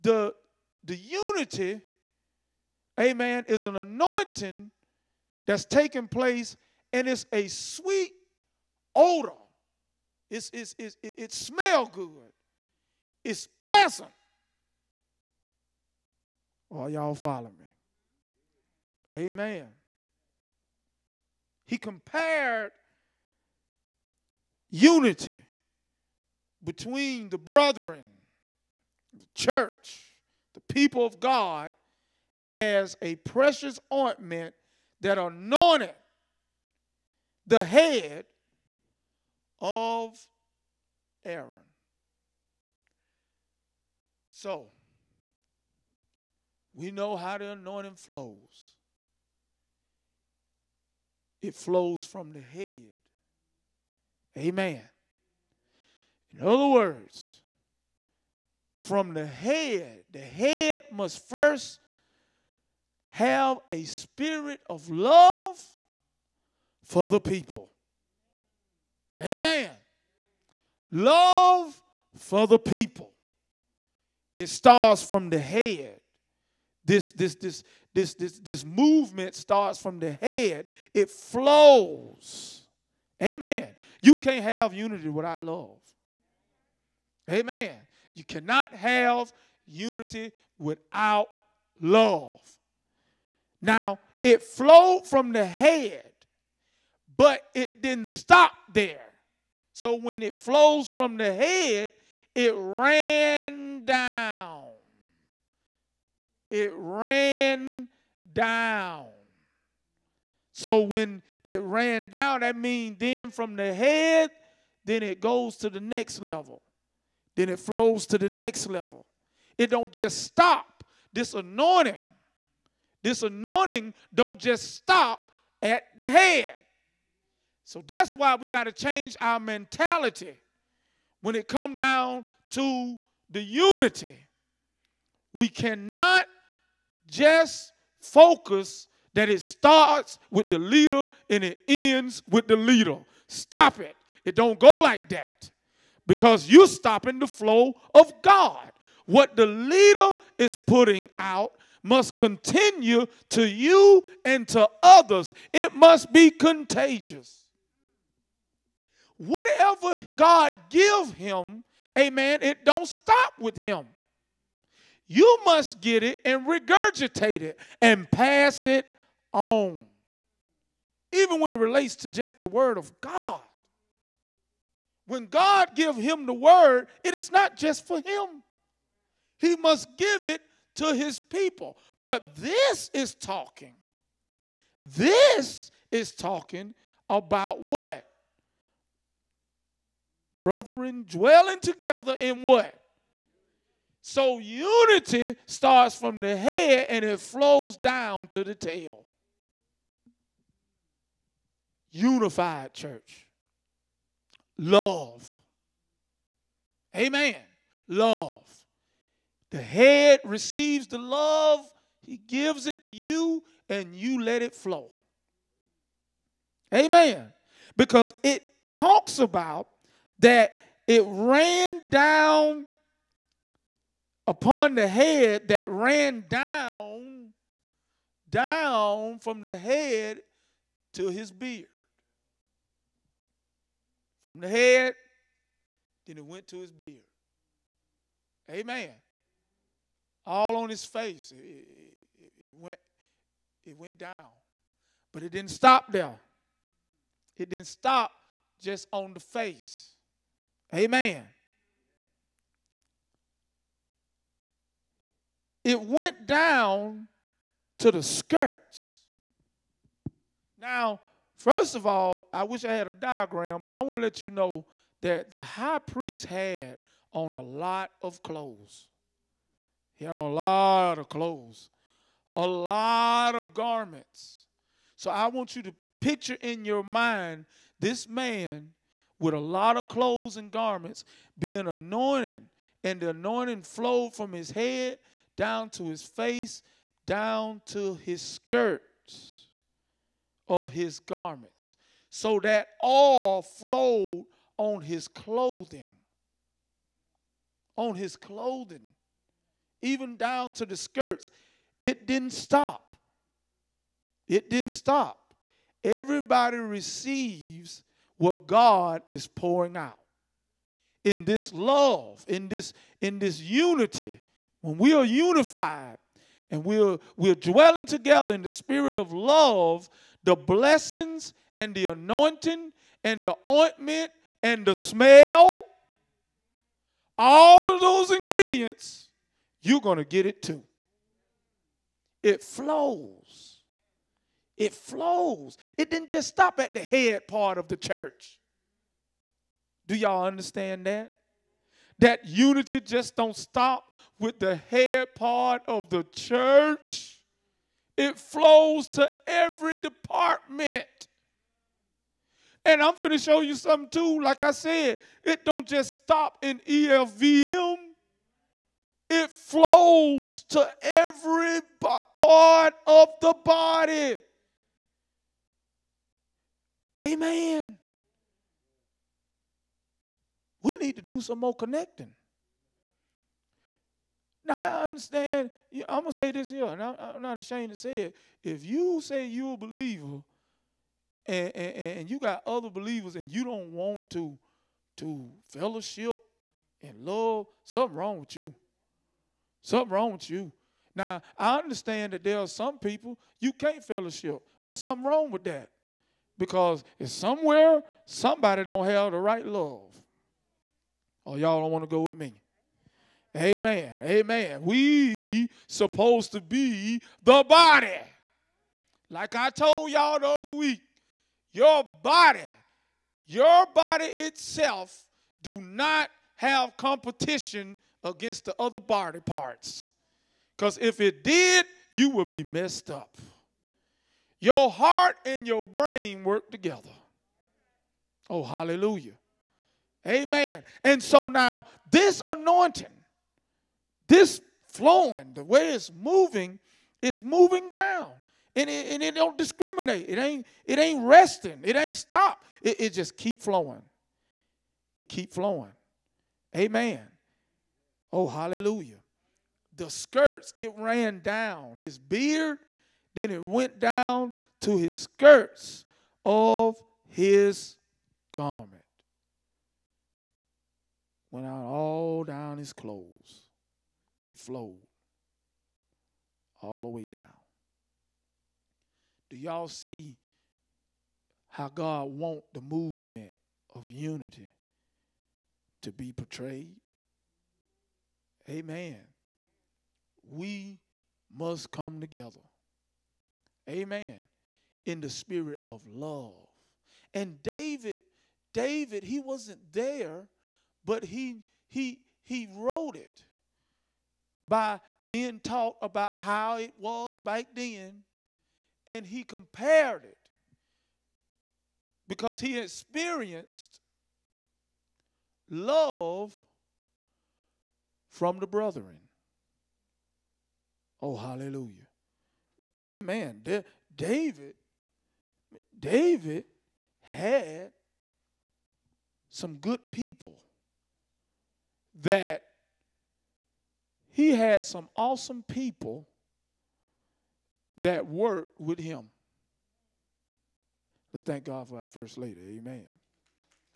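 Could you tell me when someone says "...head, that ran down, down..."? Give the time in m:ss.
3:44.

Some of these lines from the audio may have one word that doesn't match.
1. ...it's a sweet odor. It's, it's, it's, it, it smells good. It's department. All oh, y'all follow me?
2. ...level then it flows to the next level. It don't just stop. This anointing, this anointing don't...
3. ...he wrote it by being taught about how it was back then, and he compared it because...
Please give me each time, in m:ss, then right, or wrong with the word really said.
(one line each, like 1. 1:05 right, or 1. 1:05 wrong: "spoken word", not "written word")
1. 0:07 wrong: "pleasant", not "department"
2. 1:56 right
3. 8:12 right.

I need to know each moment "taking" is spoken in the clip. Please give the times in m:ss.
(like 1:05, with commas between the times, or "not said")
0:05.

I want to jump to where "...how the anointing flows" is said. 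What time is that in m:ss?
0:47.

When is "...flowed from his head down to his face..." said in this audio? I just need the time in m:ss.
4:43.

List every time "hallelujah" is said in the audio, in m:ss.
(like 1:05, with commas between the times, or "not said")
7:08, 7:28, 8:31.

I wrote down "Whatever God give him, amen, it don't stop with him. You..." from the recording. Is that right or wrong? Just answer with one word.
right.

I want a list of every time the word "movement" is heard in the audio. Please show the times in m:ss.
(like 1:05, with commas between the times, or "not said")
1:18, 7:52.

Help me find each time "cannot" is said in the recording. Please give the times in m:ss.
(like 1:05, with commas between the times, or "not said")
1:28, 2:15.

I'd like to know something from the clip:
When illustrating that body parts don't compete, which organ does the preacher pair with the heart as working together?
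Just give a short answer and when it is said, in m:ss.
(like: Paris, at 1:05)
Brain, at 7:05.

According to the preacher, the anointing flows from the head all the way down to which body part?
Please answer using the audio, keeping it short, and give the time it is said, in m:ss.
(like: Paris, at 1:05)
The tail, at 3:18.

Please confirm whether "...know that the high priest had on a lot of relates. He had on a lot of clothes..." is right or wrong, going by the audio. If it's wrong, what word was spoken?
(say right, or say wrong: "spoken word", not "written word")
wrong: "clothes", not "relates".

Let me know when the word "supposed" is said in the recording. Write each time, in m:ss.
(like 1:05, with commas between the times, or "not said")
6:45.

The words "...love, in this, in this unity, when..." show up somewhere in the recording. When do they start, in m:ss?
5:11.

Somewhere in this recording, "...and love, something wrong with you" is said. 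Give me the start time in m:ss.
6:26.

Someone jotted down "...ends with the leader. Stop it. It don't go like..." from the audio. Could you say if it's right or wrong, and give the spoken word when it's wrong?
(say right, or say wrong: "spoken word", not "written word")
right.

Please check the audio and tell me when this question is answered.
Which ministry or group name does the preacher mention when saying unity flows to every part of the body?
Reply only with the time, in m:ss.
5:56.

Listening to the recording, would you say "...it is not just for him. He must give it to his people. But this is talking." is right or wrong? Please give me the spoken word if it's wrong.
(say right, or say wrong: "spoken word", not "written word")
right.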